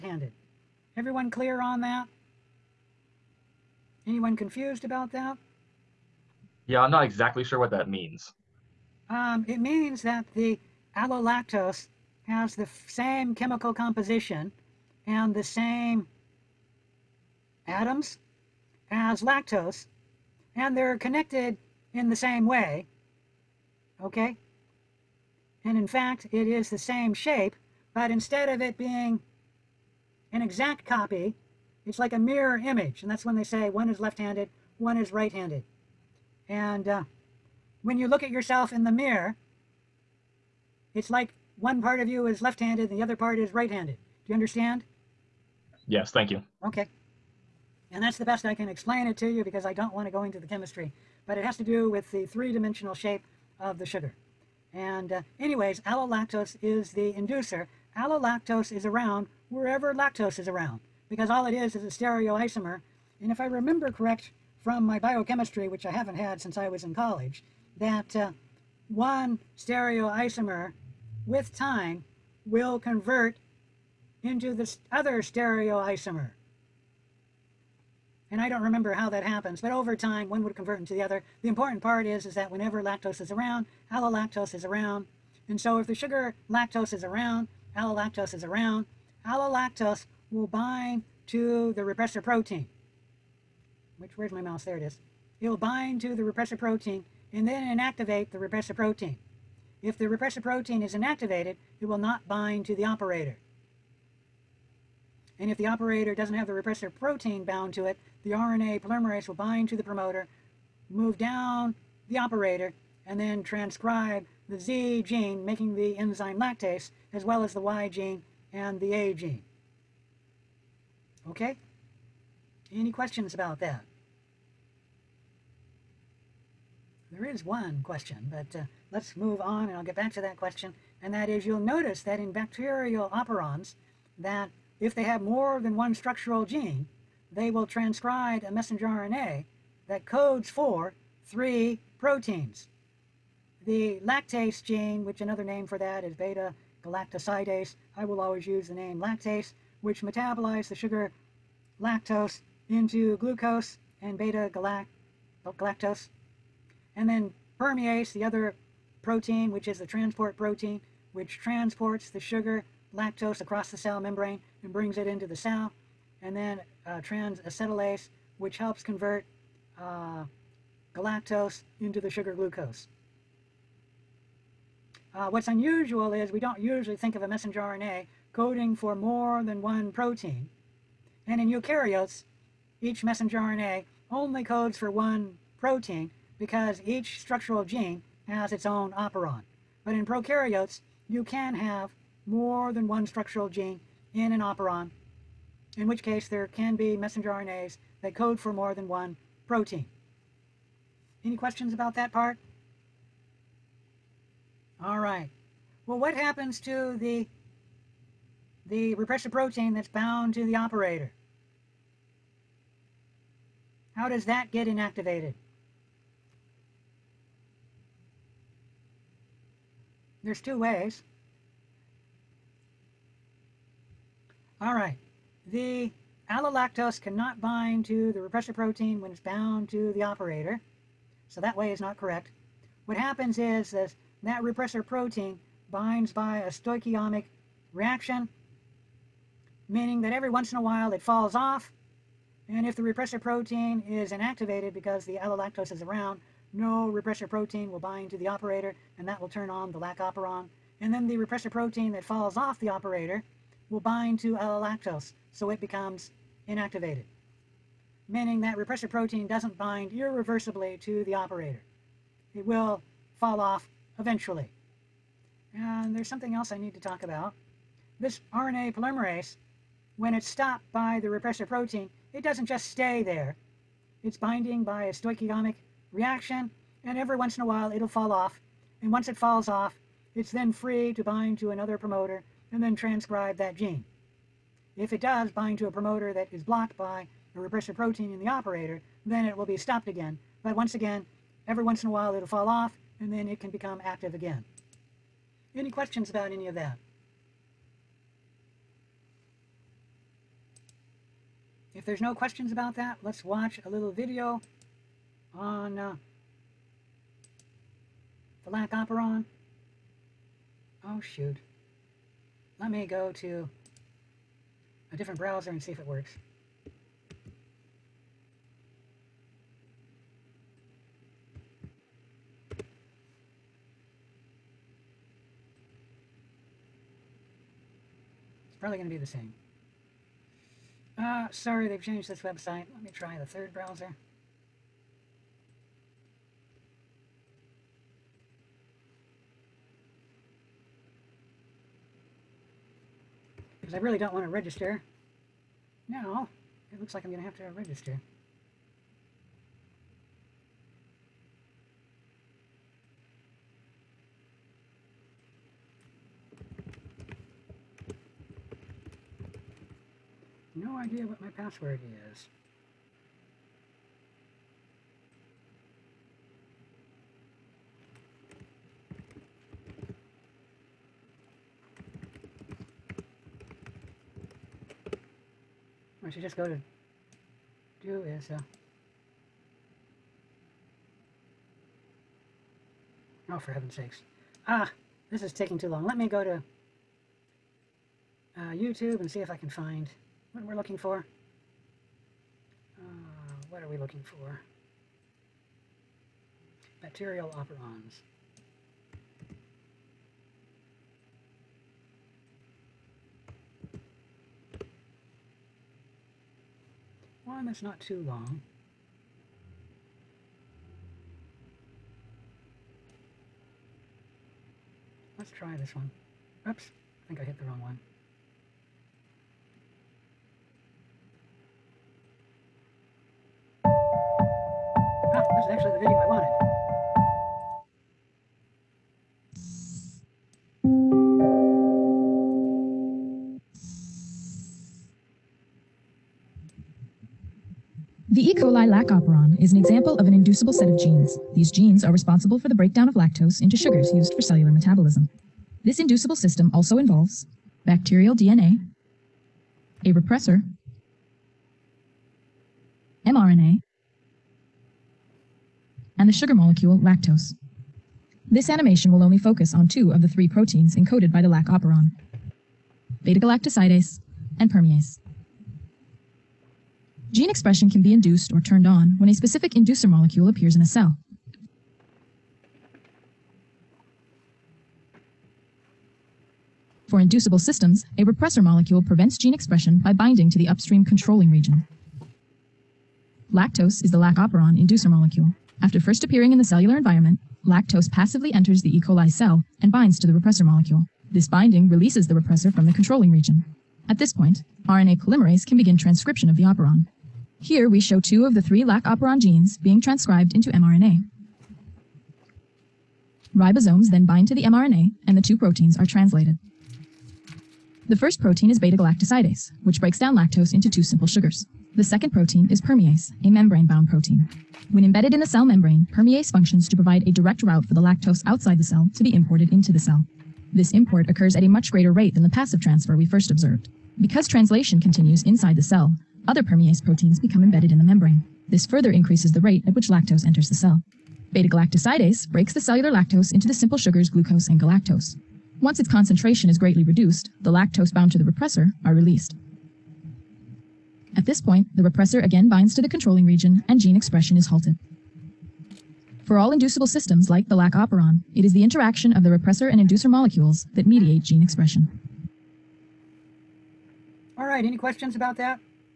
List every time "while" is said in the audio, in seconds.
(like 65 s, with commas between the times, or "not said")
240 s, 277 s, 291 s.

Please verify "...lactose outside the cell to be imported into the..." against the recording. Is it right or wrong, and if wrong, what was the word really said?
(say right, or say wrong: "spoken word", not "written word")
right.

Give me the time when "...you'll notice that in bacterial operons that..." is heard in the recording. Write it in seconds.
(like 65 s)
131 s.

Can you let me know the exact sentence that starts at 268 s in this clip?
This RNA polymerase, when it's stopped by the repressor protein, it doesn't just stay there.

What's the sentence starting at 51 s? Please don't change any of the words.
But it has to do with the three-dimensional shape of the sugar.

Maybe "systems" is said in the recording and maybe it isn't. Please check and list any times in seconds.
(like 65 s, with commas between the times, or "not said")
446 s, 477 s, 546 s.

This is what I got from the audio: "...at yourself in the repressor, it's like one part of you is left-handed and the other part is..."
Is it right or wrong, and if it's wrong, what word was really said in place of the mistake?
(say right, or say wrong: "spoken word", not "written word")
wrong: "mirror", not "repressor".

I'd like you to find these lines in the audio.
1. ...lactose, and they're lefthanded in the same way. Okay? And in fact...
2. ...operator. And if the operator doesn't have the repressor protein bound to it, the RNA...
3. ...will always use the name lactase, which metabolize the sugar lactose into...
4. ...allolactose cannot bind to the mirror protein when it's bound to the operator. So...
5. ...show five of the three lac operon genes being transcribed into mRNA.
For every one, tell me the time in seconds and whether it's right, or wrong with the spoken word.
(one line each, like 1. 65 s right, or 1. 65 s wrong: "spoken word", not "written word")
1. 19 s wrong: "connected", not "lefthanded"
2. 102 s right
3. 148 s right
4. 226 s wrong: "repressor", not "mirror"
5. 497 s wrong: "two", not "five".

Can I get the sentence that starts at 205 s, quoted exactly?
Well, what happens to the the repressor protein that's bound to the operator?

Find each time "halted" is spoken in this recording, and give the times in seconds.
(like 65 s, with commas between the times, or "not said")
544 s.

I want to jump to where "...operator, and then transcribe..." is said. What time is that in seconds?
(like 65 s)
112 s.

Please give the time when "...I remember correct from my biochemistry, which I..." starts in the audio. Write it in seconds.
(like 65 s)
63 s.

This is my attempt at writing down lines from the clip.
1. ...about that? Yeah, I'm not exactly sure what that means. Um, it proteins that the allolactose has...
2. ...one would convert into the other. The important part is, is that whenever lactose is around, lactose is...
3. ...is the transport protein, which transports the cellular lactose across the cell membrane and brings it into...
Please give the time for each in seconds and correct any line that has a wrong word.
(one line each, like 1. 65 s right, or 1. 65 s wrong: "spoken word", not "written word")
1. 4 s wrong: "means", not "proteins"
2. 80 s wrong: "allolactose", not "lactose"
3. 159 s wrong: "sugar", not "cellular".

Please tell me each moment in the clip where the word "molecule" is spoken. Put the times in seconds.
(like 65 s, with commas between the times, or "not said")
456 s, 469 s, 478 s, 484 s, 490 s, 550 s.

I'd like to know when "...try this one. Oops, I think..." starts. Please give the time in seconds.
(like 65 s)
415 s.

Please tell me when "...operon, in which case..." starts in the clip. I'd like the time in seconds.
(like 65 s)
194 s.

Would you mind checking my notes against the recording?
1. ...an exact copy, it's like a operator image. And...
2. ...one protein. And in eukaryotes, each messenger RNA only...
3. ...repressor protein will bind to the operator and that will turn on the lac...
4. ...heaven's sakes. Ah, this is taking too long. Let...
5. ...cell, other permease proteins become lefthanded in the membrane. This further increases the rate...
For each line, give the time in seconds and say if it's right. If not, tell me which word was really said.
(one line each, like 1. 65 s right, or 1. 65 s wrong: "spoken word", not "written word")
1. 30 s wrong: "mirror", not "operator"
2. 179 s right
3. 246 s right
4. 383 s right
5. 525 s wrong: "embedded", not "lefthanded".